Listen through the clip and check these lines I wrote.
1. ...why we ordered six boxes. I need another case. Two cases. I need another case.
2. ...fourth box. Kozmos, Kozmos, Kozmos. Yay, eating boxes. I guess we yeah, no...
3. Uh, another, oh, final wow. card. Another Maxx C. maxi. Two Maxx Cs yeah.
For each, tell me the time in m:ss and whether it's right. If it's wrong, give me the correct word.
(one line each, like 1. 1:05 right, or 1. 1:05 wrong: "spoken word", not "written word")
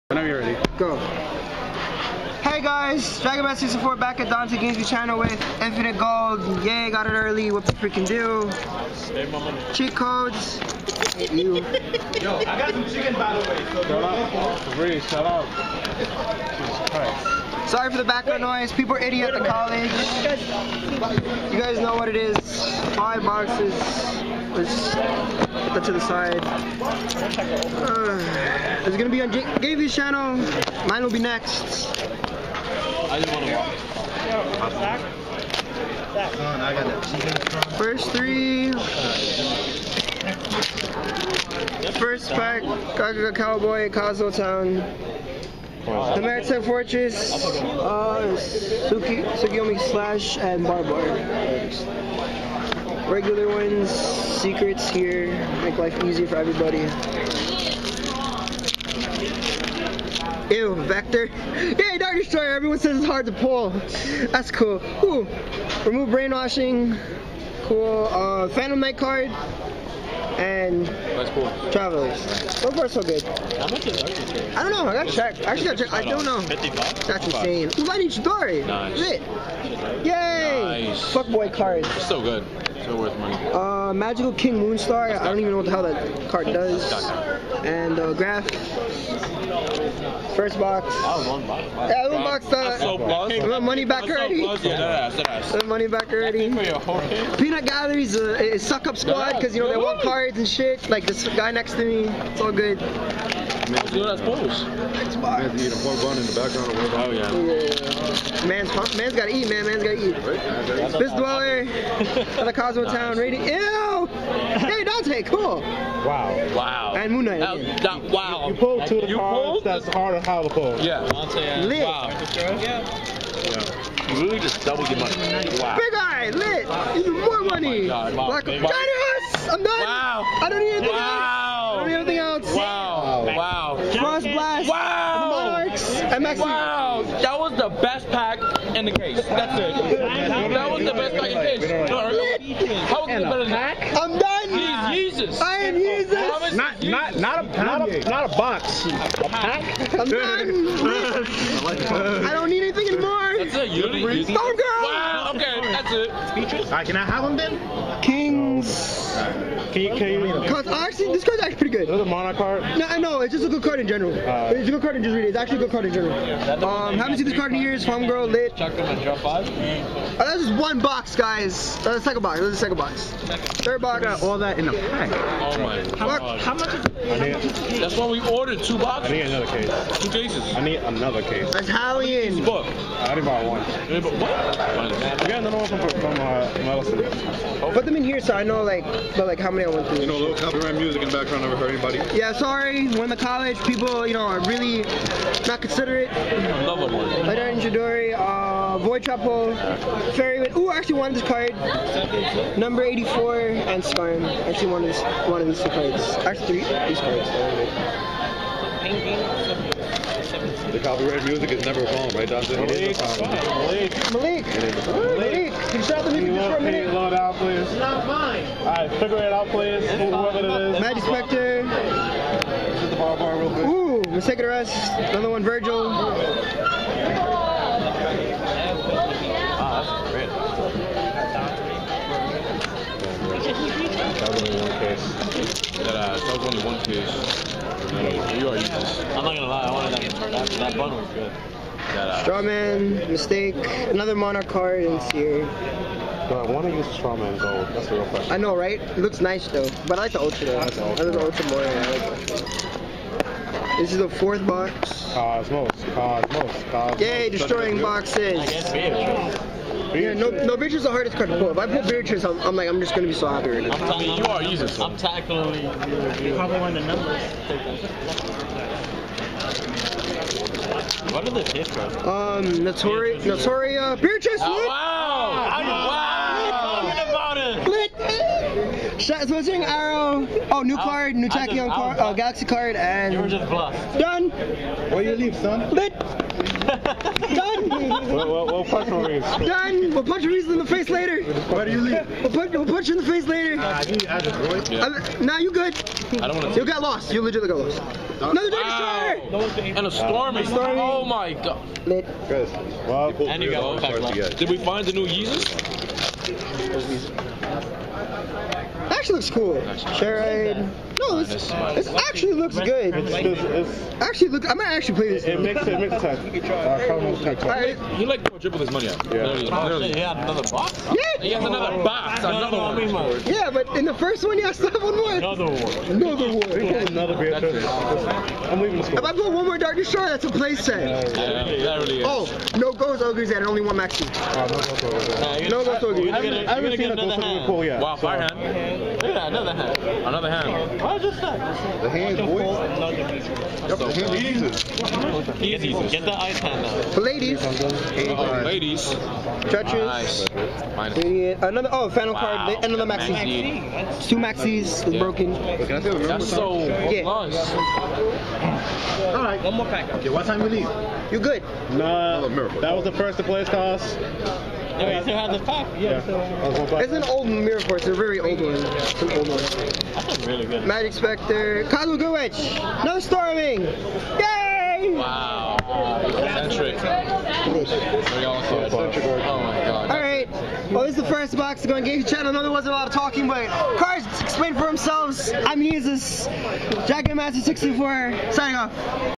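1. 2:57 wrong: "two", not "six"
2. 4:14 wrong: "destroying", not "eating"
3. 5:50 right.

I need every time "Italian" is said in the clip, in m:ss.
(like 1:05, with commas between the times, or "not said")
3:01.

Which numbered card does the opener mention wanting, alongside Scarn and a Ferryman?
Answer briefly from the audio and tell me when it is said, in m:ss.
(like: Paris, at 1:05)
Number 84, at 3:22.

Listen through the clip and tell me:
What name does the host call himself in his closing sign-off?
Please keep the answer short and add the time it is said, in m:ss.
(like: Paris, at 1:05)
Jack and Master 64, at 6:26.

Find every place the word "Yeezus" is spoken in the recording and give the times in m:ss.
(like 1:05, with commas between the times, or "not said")
5:05.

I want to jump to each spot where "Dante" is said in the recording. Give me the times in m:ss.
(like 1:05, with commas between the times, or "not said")
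0:04, 1:54, 2:01, 3:32.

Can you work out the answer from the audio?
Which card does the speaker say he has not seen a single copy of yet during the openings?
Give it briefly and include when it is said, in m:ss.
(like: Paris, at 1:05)
Ghost Ogre, at 5:36.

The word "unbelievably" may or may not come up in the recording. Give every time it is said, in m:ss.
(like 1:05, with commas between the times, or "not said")
not said.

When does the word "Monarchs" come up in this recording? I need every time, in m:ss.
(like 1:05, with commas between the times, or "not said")
2:15, 4:04.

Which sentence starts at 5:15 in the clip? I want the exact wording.
It, it makes it makes sense.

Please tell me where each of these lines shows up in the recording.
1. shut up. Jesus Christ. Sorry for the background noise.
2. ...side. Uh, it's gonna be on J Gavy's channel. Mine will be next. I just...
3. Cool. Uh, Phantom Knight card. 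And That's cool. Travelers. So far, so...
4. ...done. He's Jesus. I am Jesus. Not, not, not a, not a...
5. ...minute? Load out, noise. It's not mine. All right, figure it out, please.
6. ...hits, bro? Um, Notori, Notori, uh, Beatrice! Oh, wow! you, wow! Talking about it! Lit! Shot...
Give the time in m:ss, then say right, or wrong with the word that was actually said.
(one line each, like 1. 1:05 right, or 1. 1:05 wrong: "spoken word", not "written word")
1. 0:15 right
2. 0:26 right
3. 1:07 right
4. 2:24 right
5. 3:36 wrong: "please", not "noise"
6. 4:31 right.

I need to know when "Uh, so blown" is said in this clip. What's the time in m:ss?
1:32.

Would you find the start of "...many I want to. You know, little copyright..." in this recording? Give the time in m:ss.
3:09.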